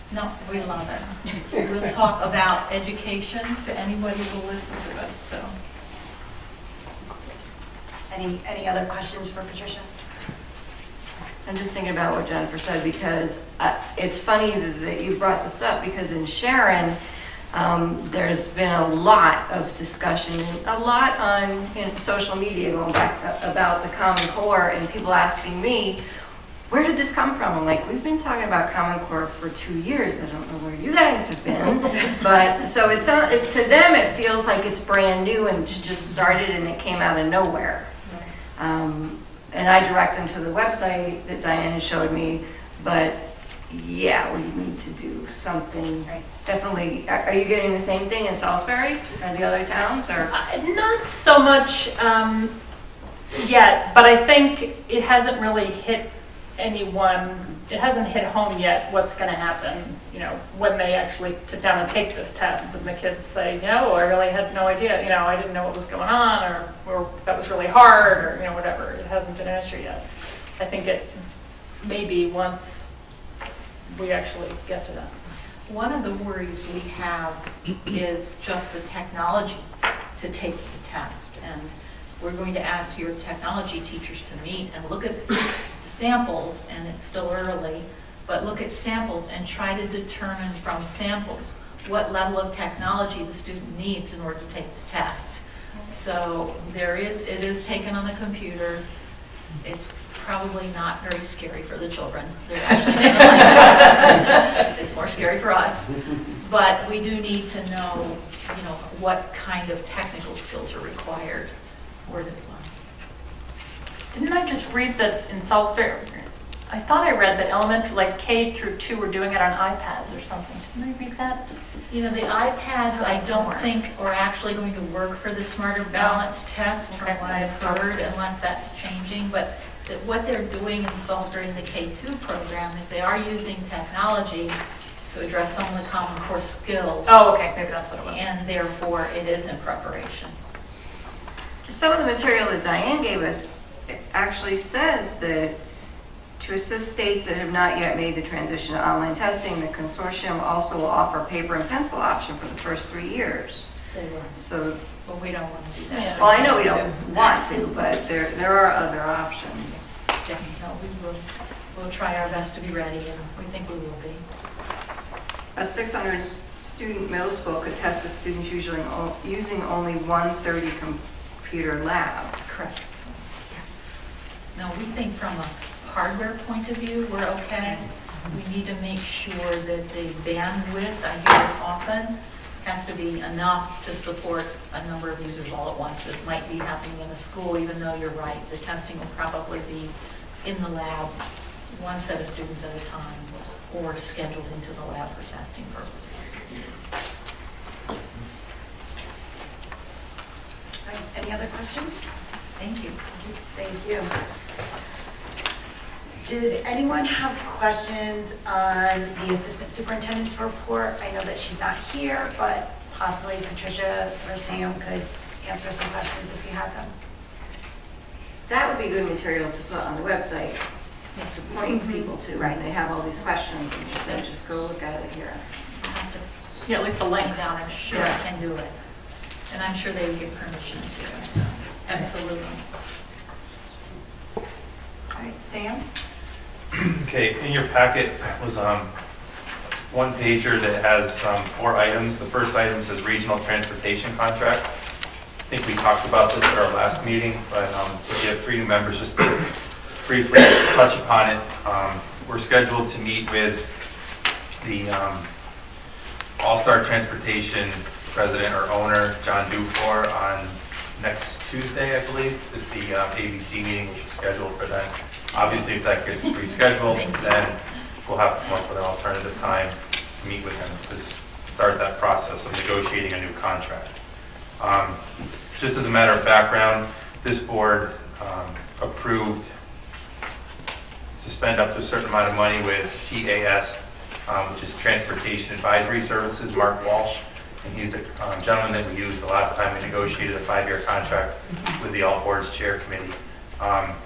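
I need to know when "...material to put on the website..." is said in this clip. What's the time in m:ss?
3:39.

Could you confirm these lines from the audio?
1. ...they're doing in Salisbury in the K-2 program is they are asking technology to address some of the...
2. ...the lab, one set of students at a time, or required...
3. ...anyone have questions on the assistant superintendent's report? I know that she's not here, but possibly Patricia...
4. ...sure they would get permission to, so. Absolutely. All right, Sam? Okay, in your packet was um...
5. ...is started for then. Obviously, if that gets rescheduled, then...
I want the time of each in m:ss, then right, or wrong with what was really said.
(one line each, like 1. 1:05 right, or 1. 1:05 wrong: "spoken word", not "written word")
1. 2:10 wrong: "using", not "asking"
2. 3:10 wrong: "scheduled", not "required"
3. 3:26 right
4. 3:49 right
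5. 4:24 wrong: "scheduled", not "started".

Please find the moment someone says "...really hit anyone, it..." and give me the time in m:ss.
0:55.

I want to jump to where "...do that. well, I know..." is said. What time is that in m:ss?
2:35.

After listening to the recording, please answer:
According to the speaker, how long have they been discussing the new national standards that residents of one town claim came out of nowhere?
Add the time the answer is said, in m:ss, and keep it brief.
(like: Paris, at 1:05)
2 years, at 0:29.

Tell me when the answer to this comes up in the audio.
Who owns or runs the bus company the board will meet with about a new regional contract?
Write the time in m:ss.
4:19.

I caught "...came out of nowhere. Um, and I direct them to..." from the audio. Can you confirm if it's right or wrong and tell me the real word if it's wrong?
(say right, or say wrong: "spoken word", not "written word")
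right.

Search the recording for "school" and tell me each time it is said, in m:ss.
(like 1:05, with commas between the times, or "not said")
2:47, 3:07.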